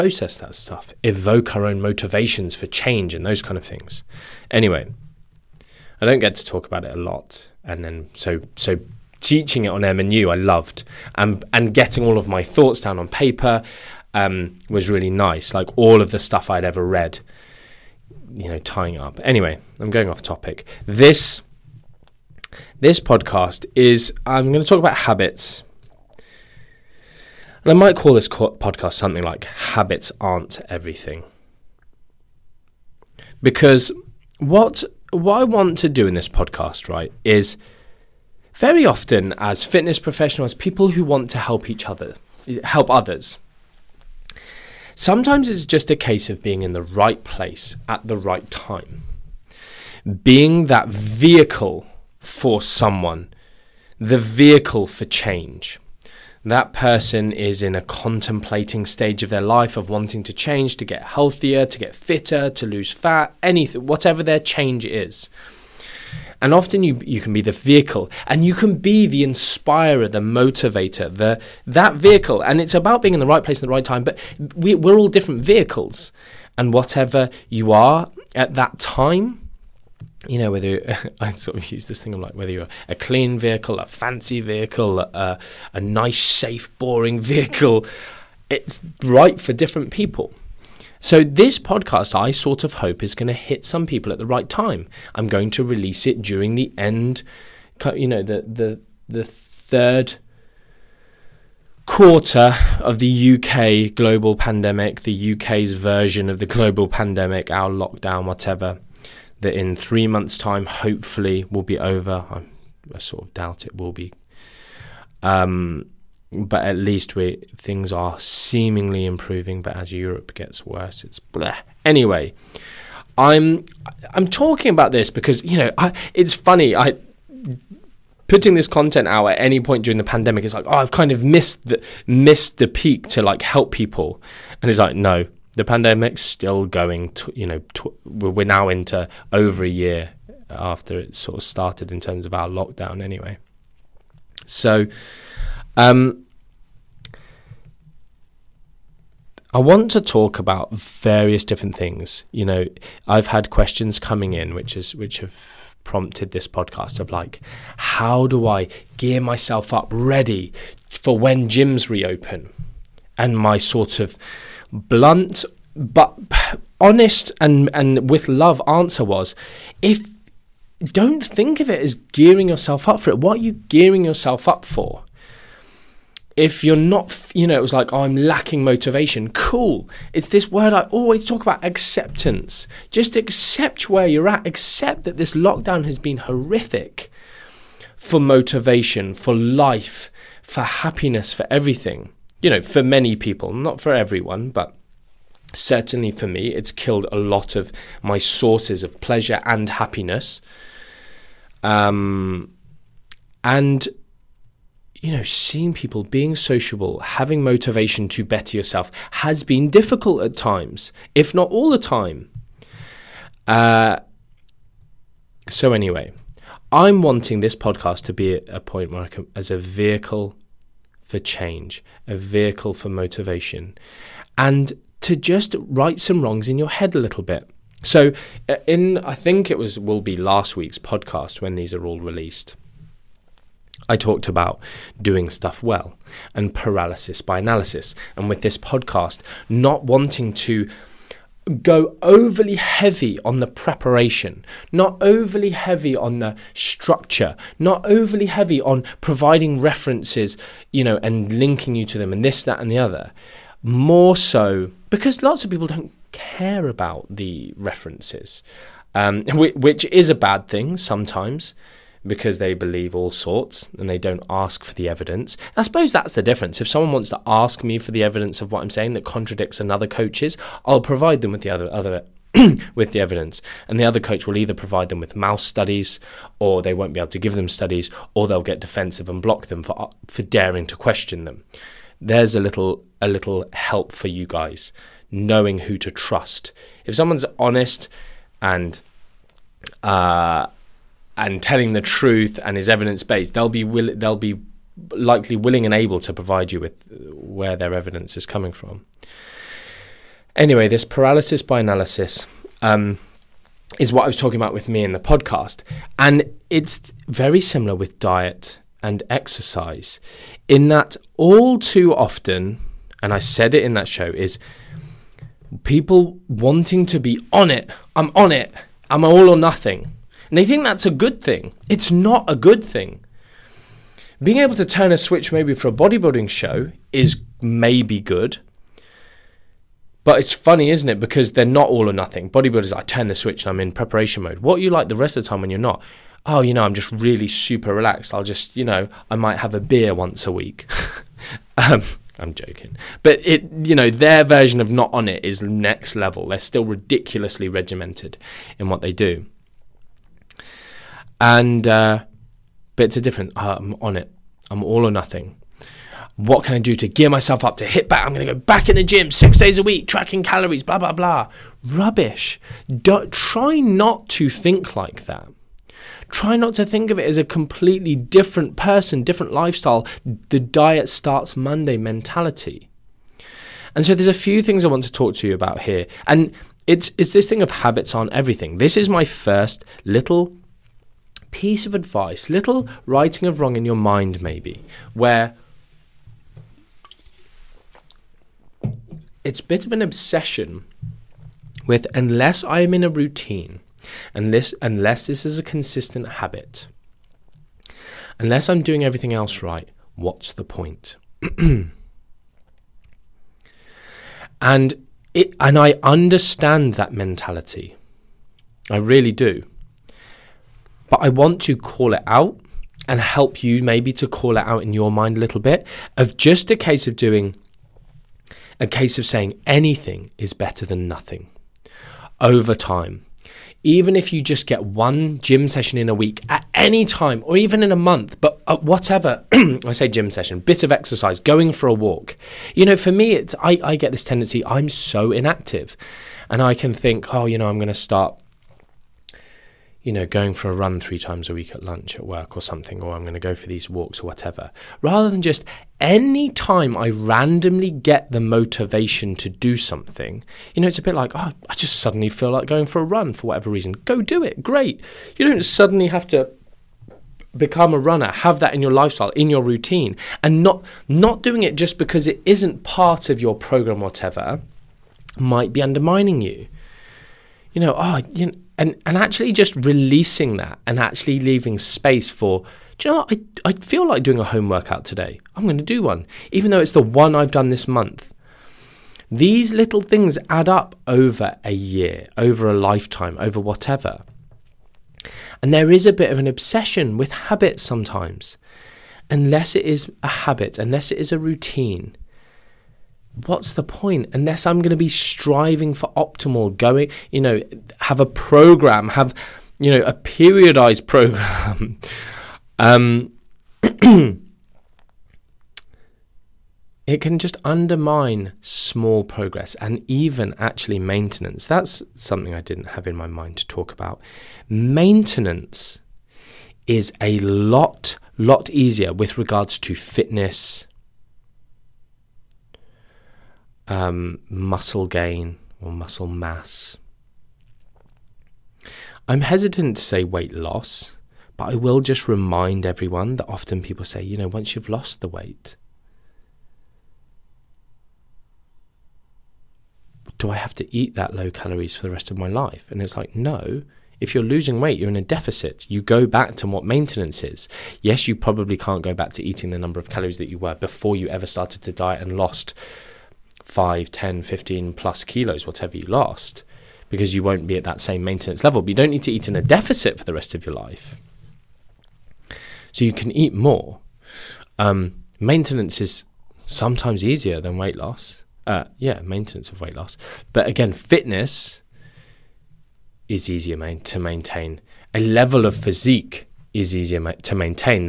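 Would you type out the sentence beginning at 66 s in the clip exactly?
And often you, you can be the vehicle and you can be the inspirer, the motivator, the, that vehicle.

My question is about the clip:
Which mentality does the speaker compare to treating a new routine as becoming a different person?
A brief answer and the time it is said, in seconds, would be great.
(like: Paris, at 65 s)
The diet starts Monday, at 370 s.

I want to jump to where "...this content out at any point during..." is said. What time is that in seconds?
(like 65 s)
128 s.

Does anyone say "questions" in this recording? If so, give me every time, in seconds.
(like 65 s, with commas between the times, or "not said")
153 s, 280 s.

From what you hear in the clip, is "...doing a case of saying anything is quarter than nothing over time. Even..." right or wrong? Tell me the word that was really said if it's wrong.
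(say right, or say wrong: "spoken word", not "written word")
wrong: "better", not "quarter".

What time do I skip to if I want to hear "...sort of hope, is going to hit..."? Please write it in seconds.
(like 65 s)
92 s.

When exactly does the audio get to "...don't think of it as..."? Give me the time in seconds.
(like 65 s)
170 s.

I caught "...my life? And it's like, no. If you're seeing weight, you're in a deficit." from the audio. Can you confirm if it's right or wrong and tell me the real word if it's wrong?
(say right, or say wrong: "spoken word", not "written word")
wrong: "losing", not "seeing".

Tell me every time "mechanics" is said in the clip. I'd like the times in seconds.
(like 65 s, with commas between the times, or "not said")
not said.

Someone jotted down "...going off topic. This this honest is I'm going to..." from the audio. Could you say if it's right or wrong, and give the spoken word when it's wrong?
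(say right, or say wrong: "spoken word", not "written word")
wrong: "podcast", not "honest".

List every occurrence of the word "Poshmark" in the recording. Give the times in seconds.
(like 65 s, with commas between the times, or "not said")
not said.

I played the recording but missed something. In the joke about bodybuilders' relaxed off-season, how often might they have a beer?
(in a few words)
once a week.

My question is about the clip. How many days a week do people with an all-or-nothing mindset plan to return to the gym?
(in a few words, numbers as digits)
6.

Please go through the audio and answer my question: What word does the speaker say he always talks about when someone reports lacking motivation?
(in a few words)
acceptance.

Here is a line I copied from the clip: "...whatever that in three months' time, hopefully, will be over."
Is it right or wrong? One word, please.
right.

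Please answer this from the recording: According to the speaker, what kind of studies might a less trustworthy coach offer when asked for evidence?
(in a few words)
mouse studies.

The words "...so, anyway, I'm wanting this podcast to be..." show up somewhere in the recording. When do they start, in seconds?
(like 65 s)
215 s.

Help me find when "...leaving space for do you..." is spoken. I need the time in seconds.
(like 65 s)
471 s.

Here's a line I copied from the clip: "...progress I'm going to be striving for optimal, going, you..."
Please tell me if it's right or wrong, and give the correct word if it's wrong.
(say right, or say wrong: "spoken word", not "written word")
wrong: "unless", not "progress".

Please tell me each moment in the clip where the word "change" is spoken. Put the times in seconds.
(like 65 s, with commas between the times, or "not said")
2 s, 55 s, 60 s, 64 s, 221 s.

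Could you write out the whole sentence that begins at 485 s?
And there is a bit of an obsession with habits sometimes.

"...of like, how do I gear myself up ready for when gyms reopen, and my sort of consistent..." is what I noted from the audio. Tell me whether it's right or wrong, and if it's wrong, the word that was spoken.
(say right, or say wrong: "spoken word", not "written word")
wrong: "blunt", not "consistent".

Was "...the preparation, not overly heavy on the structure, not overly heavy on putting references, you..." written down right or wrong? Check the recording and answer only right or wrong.
wrong.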